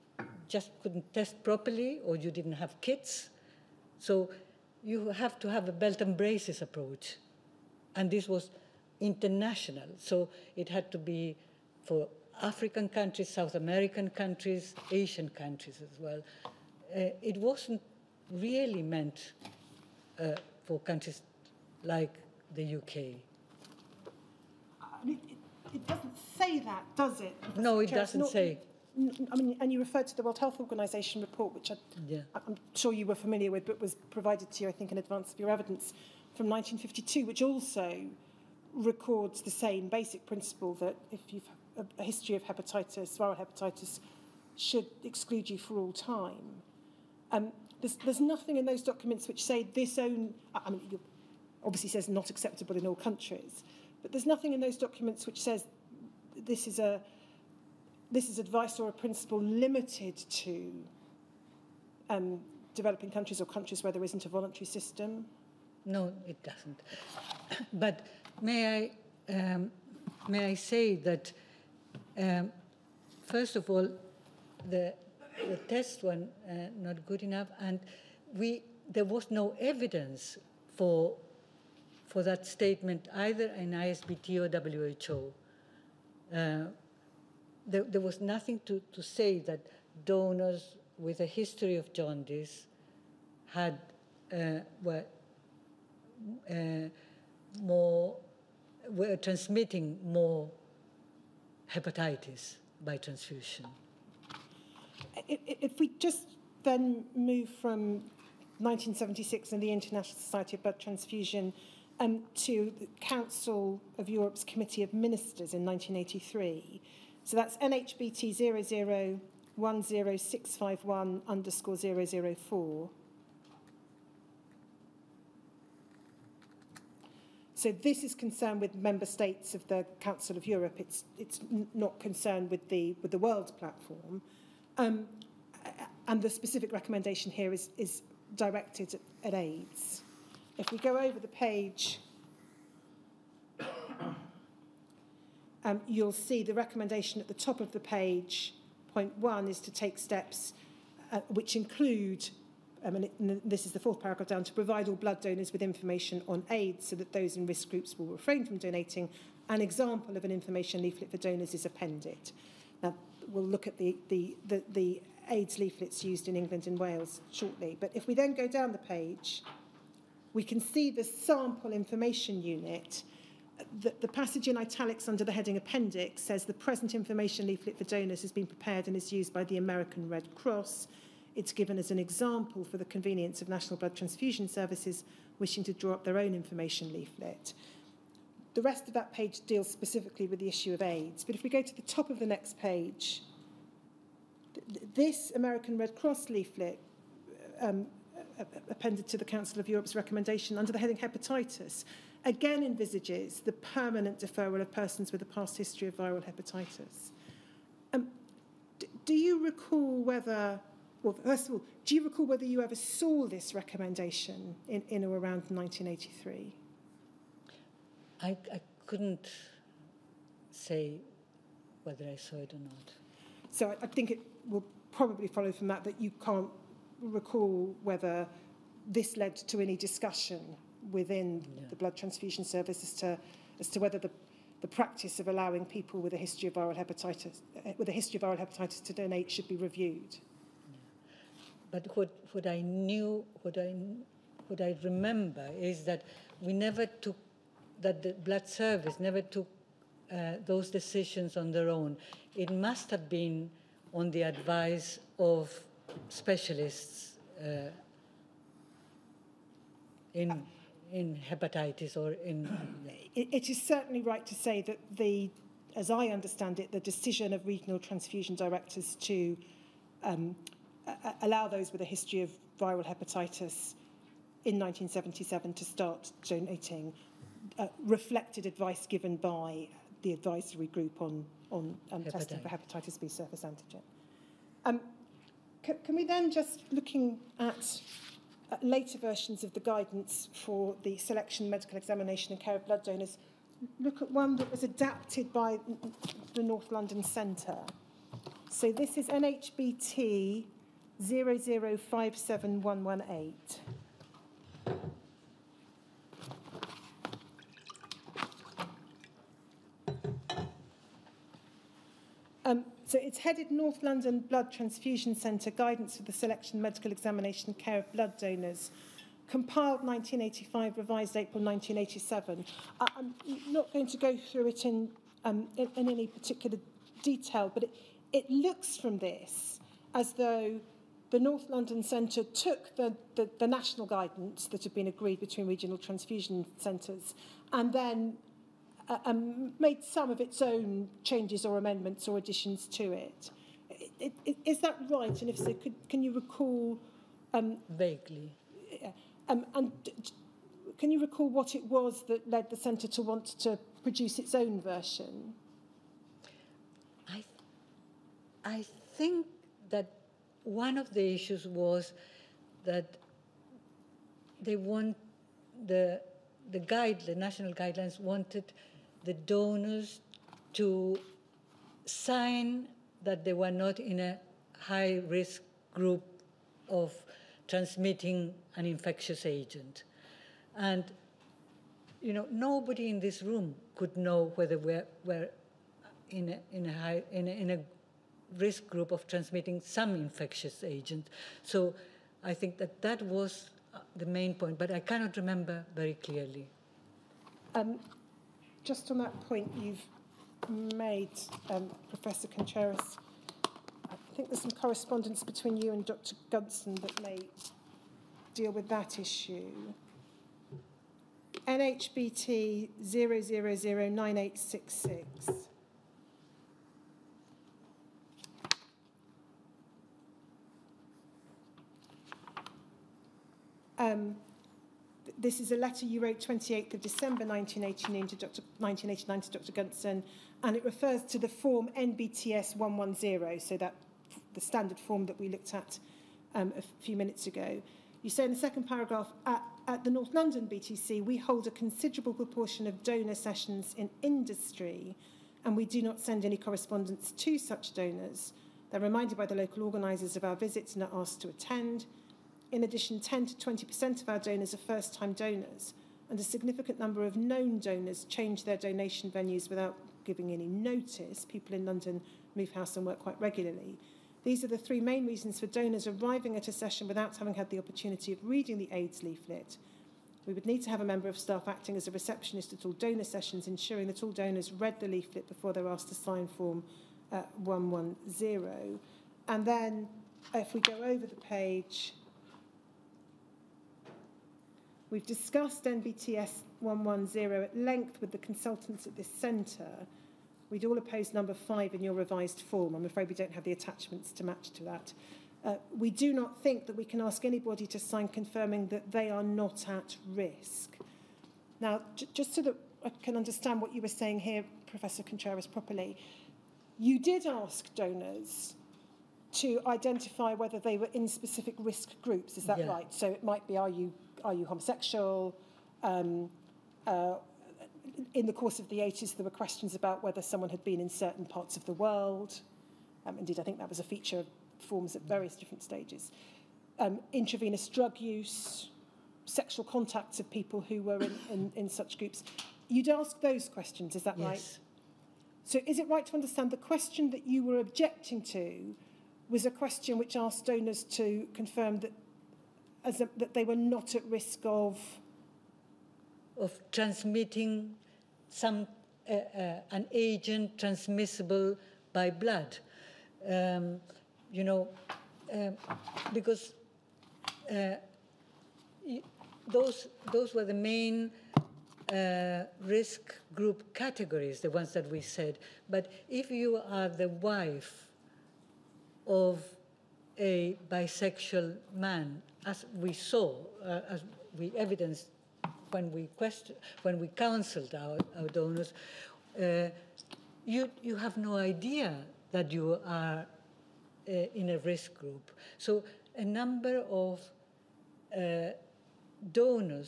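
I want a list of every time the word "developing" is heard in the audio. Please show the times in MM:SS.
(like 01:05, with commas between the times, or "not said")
01:02.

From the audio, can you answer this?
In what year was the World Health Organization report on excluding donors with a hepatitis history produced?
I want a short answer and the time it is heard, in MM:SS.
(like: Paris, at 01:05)
1952, at 00:36.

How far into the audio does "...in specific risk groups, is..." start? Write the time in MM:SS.
08:30.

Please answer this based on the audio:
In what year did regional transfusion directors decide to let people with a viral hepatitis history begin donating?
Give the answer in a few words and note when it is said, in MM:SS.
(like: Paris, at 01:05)
1977, at 04:34.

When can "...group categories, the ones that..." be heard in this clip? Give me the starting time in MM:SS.
09:23.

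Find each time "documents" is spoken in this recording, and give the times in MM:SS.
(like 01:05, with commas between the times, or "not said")
00:48, 00:54.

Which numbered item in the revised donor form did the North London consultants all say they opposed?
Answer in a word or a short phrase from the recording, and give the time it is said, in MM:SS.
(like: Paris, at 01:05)
Number 5, at 08:11.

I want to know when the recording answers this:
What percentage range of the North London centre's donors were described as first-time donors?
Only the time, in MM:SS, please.
07:32.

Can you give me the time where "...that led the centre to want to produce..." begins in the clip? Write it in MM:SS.
05:52.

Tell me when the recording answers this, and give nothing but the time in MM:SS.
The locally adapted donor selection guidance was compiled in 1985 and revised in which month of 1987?
05:21.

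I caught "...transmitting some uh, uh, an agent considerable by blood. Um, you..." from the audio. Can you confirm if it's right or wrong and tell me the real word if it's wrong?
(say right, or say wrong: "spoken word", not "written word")
wrong: "transmissible", not "considerable".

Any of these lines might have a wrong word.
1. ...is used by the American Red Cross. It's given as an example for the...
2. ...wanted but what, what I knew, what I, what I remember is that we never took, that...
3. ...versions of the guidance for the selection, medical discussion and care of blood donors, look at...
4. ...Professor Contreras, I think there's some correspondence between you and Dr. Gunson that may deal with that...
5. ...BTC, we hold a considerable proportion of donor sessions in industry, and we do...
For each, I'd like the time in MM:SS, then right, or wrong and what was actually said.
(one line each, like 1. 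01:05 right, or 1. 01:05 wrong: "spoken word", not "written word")
1. 02:58 right
2. 03:59 wrong: "reviewed", not "wanted"
3. 04:48 wrong: "examination", not "discussion"
4. 06:41 right
5. 07:20 right.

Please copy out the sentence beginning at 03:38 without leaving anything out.
I, I couldn't say whether I saw it or not.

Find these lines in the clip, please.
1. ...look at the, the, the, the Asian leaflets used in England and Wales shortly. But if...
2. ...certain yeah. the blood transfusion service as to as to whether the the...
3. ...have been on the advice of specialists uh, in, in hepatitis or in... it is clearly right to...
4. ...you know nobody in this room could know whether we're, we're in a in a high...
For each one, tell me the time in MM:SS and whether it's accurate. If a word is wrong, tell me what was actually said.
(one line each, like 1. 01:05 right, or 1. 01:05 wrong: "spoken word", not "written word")
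1. 02:43 wrong: "AIDS", not "Asian"
2. 03:50 wrong: "within", not "certain"
3. 04:12 wrong: "certainly", not "clearly"
4. 06:22 right.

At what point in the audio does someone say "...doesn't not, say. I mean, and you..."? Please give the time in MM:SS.
00:27.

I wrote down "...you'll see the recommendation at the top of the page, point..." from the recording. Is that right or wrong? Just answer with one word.
right.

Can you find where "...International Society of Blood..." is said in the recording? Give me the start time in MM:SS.
01:49.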